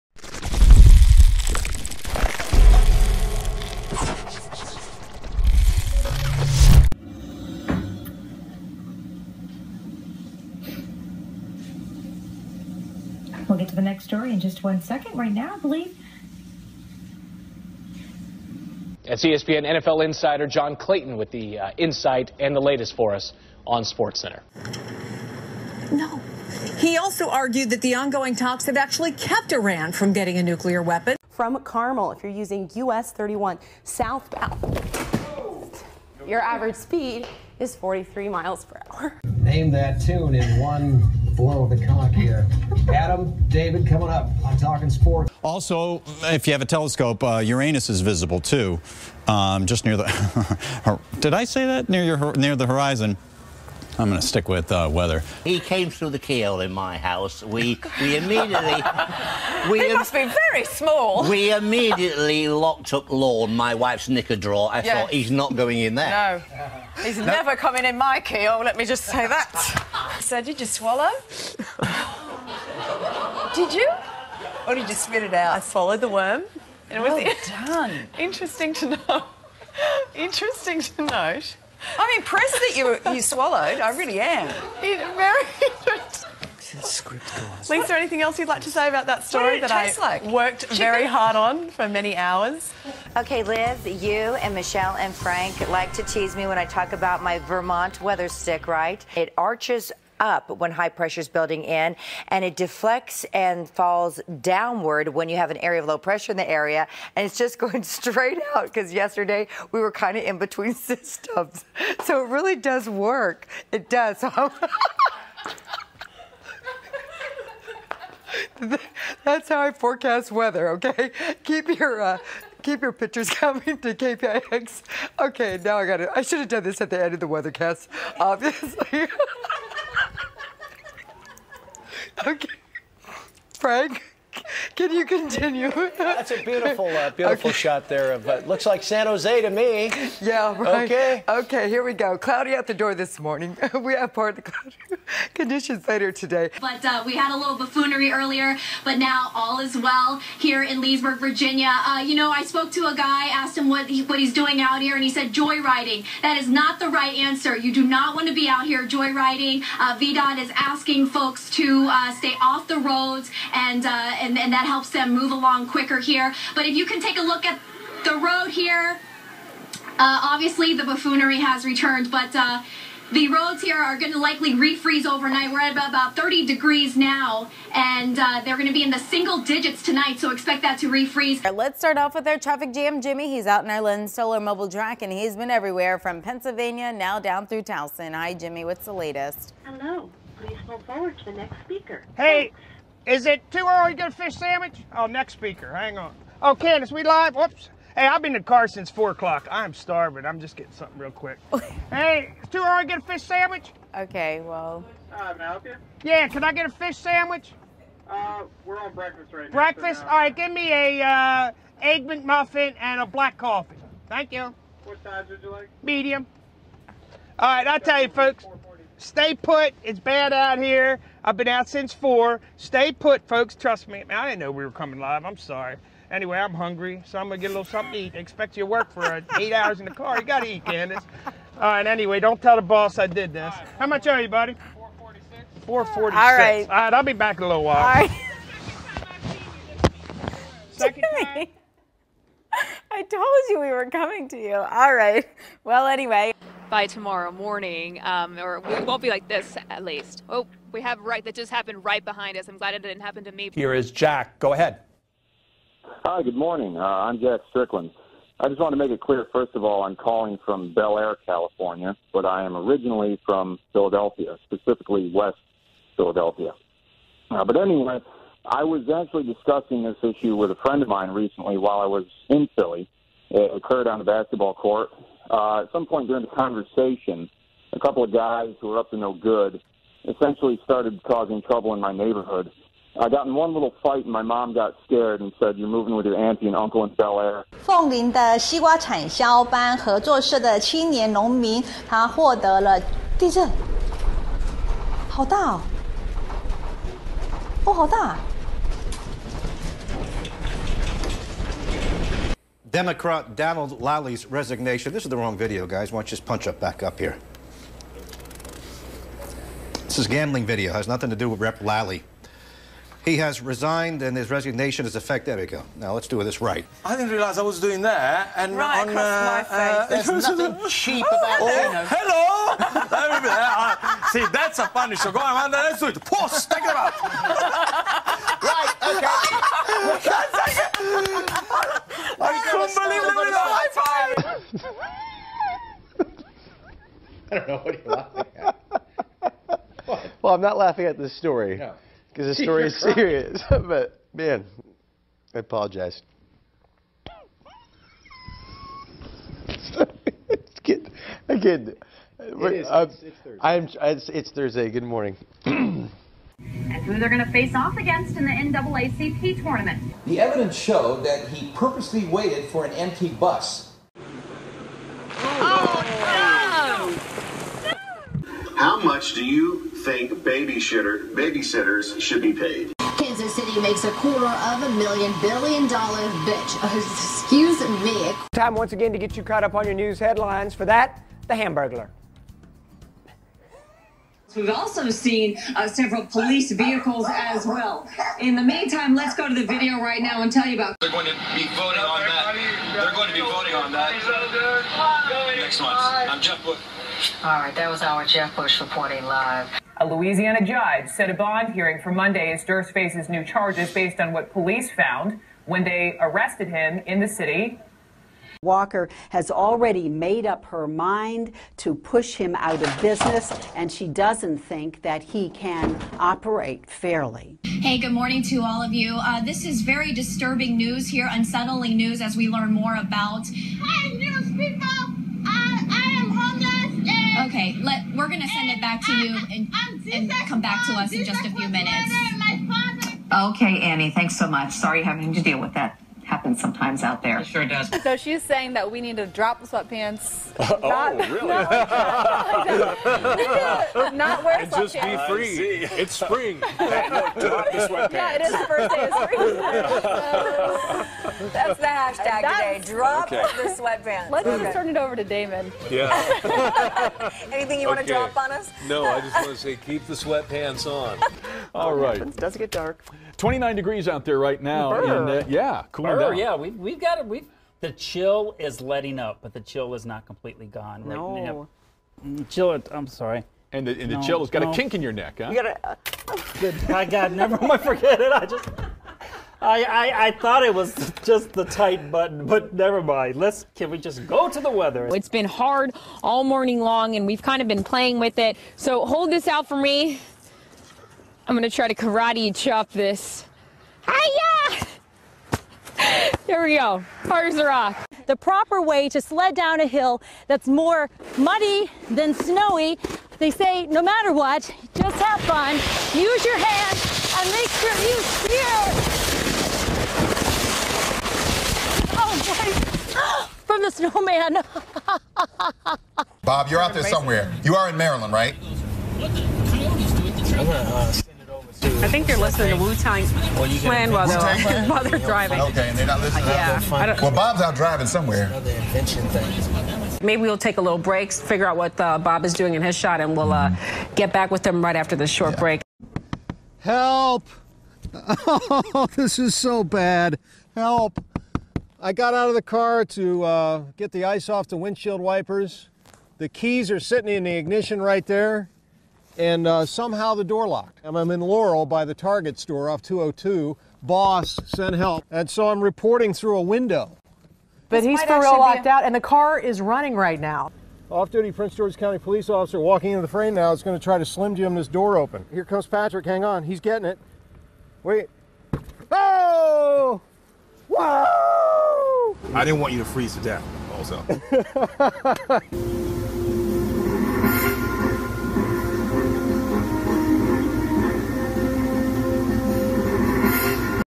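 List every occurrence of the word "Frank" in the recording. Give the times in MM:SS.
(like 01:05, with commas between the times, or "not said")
01:35, 02:13.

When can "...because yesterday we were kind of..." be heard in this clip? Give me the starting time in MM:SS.
01:48.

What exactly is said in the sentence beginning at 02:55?
We're at about 30 degrees now, and uh, they're going to be in the single digits tonight, so expect that to refreeze.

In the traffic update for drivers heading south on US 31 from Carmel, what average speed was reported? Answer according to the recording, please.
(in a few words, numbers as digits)
43 mph.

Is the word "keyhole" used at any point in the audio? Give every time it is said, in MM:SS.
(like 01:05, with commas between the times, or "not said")
00:56, 01:08.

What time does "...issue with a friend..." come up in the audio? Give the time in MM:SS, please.
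04:30.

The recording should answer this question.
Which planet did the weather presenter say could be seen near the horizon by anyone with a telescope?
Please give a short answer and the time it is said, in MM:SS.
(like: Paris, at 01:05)
Uranus, at 00:47.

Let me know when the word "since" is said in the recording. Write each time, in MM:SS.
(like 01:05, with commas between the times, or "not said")
03:18, 03:41.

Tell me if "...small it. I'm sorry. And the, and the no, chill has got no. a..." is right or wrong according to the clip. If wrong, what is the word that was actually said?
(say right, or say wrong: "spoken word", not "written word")
wrong: "chill", not "small".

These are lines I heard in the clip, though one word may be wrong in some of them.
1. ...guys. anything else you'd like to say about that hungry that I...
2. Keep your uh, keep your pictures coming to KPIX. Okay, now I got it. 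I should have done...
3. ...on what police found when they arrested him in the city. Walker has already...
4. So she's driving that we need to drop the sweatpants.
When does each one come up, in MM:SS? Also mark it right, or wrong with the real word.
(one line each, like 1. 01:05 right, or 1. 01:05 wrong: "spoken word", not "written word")
1. 01:27 wrong: "story", not "hungry"
2. 02:01 right
3. 06:43 right
4. 07:17 wrong: "saying", not "driving".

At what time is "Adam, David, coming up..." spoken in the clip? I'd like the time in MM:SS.
00:42.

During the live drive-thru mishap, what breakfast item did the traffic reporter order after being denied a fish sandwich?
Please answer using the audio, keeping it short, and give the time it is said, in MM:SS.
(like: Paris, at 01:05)
Egg McMuffin, at 03:31.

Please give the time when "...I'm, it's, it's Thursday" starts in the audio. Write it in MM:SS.
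05:53.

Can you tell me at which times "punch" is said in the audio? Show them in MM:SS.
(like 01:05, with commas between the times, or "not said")
05:06.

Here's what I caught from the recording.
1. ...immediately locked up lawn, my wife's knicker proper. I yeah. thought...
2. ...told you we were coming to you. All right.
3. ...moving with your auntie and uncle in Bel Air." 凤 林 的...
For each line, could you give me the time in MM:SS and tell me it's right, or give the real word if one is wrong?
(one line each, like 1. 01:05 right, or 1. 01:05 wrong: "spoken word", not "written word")
1. 01:01 wrong: "drawer", not "proper"
2. 04:03 right
3. 04:45 right.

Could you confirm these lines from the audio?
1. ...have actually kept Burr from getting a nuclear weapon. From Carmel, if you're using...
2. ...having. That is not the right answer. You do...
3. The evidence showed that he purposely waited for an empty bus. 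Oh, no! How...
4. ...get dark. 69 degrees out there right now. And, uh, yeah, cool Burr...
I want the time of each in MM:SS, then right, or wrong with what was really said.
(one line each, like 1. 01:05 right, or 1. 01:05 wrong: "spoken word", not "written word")
1. 00:28 wrong: "Iran", not "Burr"
2. 02:35 wrong: "joyriding", not "having"
3. 06:00 right
4. 07:42 wrong: "29", not "69".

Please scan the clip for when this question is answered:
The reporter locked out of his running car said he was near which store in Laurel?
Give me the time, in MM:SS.
09:11.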